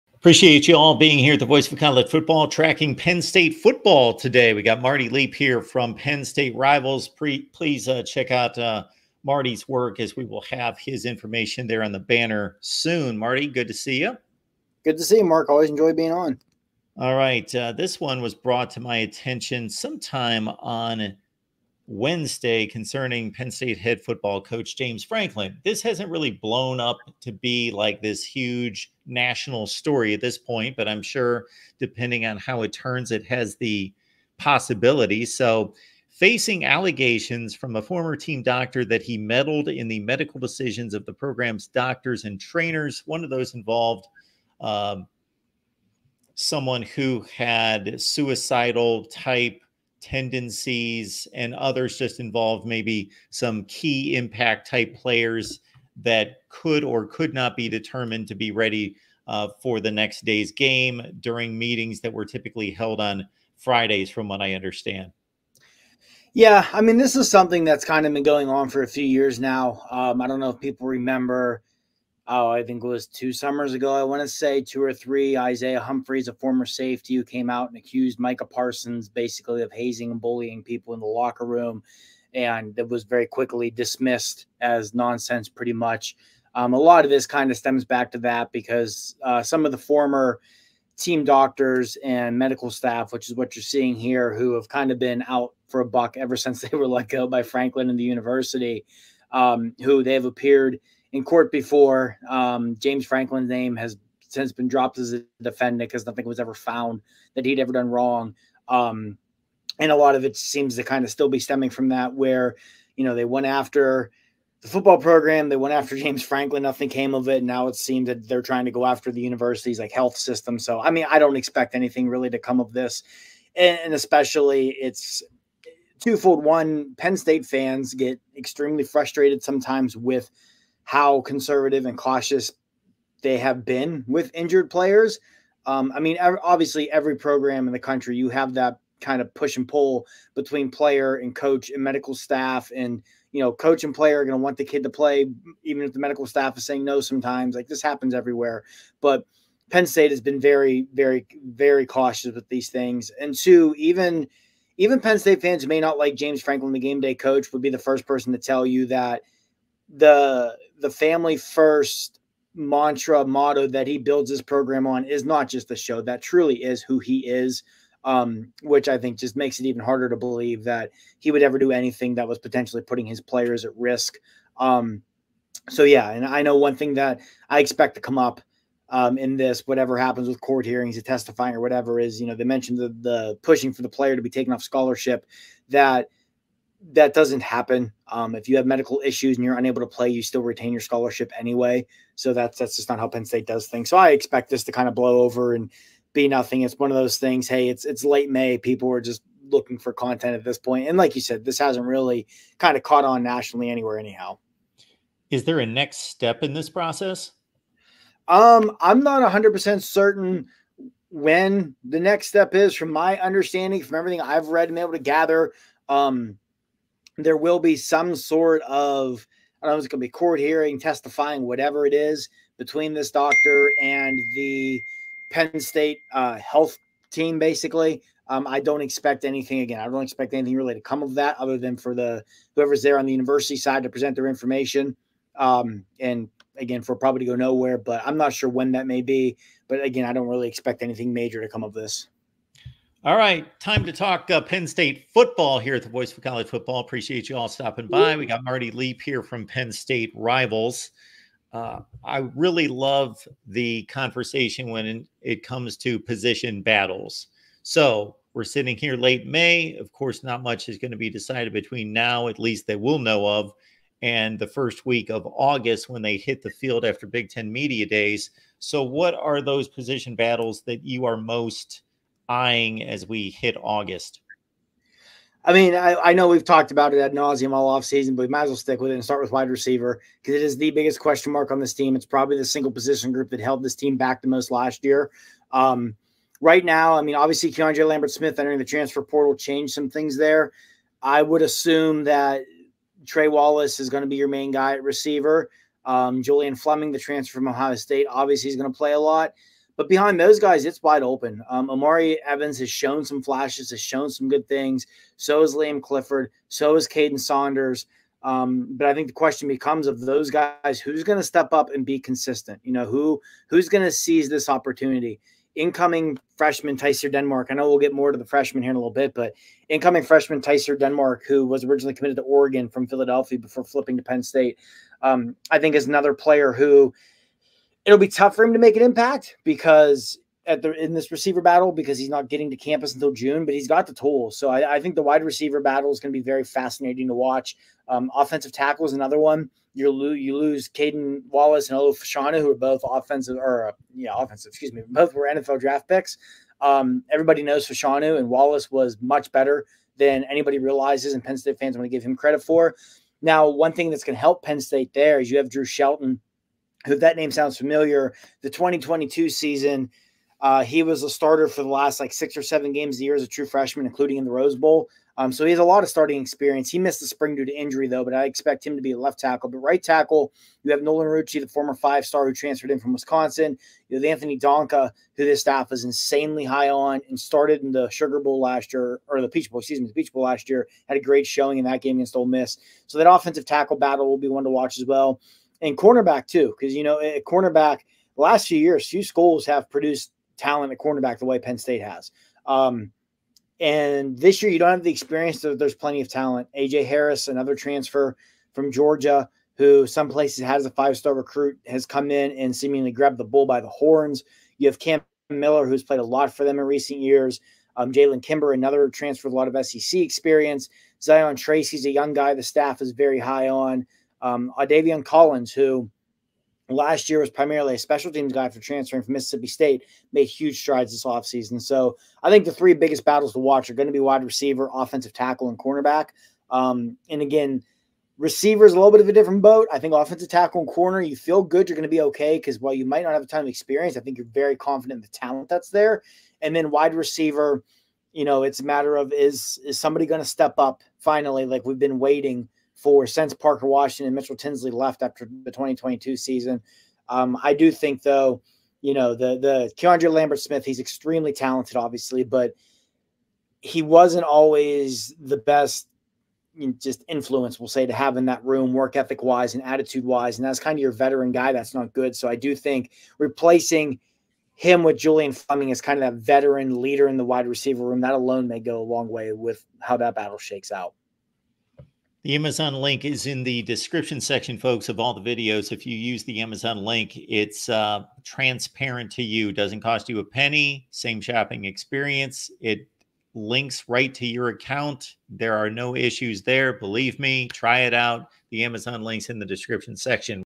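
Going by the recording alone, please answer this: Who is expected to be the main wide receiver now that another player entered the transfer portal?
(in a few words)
Trey Wallace.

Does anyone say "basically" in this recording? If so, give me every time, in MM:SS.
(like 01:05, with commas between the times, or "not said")
01:19, 03:47.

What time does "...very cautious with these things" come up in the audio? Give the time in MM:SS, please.
02:31.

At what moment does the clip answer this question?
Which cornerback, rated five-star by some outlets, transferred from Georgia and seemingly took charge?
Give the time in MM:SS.
06:36.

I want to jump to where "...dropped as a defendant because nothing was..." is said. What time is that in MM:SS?
01:44.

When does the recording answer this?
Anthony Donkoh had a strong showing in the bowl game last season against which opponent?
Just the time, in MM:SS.
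06:22.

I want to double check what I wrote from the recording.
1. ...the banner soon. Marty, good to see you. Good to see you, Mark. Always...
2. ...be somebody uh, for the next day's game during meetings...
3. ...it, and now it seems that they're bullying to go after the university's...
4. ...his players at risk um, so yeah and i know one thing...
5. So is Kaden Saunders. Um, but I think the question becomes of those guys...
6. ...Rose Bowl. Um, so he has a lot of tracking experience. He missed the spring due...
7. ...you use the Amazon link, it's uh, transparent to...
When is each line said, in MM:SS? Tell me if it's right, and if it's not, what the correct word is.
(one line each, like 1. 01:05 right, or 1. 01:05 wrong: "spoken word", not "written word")
1. 00:11 right
2. 00:58 wrong: "ready", not "somebody"
3. 01:57 wrong: "trying", not "bullying"
4. 02:53 right
5. 05:06 right
6. 06:04 wrong: "starting", not "tracking"
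7. 07:55 right.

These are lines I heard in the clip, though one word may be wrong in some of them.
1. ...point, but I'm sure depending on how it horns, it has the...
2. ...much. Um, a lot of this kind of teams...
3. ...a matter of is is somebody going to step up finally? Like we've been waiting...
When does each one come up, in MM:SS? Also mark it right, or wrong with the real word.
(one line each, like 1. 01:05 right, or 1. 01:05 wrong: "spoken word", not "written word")
1. 00:30 wrong: "turns", not "horns"
2. 01:25 wrong: "stems", not "teams"
3. 07:18 right.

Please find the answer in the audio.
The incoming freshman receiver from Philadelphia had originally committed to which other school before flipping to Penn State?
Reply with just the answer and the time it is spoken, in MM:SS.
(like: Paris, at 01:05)
Oregon, at 05:22.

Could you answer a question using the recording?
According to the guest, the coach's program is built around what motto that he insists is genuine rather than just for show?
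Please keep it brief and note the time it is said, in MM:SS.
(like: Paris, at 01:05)
Family first, at 02:40.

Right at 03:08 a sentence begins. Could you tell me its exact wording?
Um, if you have medical issues and you're unable to play, you still retain your scholarship anyway.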